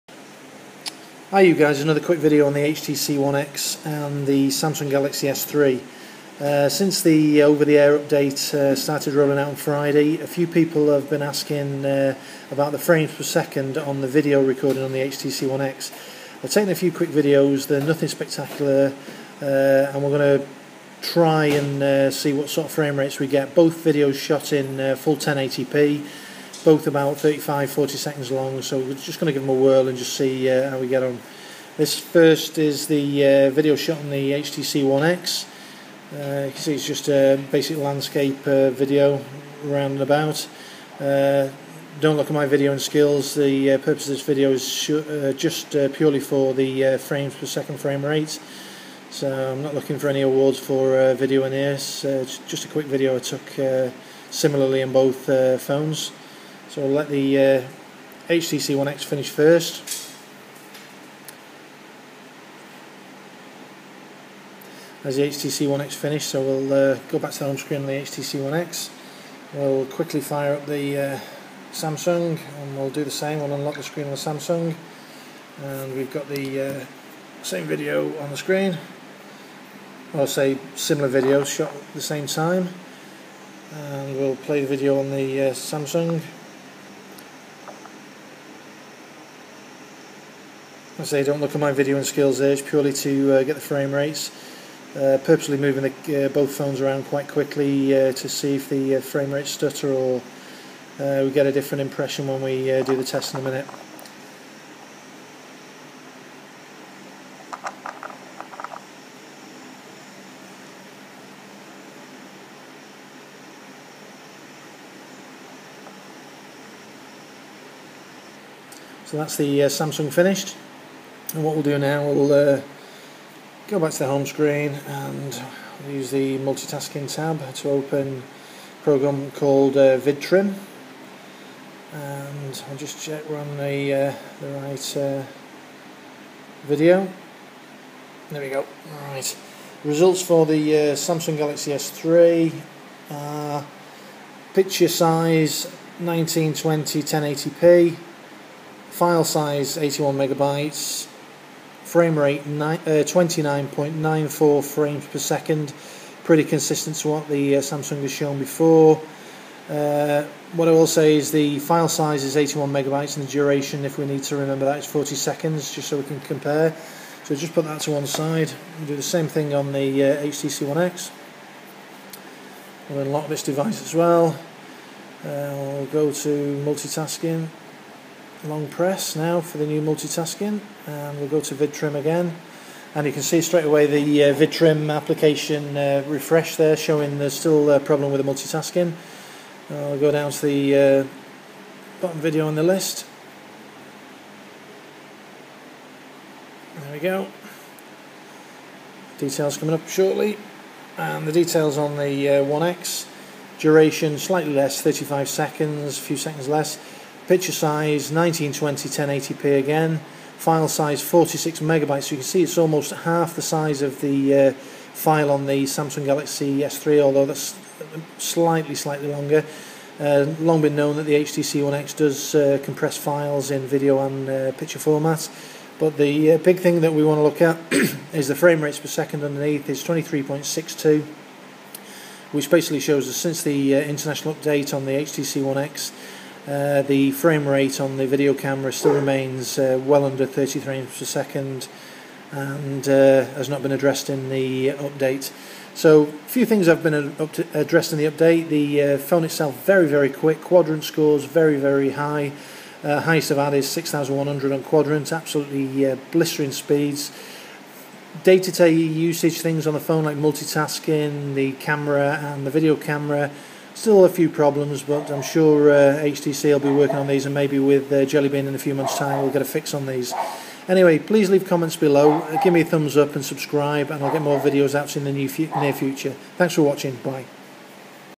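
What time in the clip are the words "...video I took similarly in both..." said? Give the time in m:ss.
0:52.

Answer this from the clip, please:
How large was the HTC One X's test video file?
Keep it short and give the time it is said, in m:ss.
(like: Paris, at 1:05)
46 megabytes, at 3:31.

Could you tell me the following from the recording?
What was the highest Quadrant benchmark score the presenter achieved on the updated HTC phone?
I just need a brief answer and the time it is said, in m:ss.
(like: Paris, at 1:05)
6100, at 4:13.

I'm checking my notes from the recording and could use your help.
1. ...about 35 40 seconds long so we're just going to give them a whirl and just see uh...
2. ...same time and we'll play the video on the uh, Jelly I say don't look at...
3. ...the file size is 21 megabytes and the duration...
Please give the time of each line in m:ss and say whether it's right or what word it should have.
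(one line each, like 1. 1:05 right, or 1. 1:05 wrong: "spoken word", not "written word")
1. 0:26 right
2. 1:22 wrong: "Samsung", not "Jelly"
3. 2:41 wrong: "81", not "21".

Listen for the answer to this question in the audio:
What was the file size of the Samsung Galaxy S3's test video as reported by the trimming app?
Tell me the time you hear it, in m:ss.
2:28.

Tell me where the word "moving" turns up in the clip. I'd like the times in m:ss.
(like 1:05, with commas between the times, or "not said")
1:35.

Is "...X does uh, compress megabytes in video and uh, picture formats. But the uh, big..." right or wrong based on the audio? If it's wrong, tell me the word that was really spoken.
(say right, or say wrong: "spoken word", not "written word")
wrong: "files", not "megabytes".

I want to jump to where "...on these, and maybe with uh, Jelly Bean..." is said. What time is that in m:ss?
4:26.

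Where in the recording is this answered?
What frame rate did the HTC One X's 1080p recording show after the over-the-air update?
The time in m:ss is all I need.
3:49.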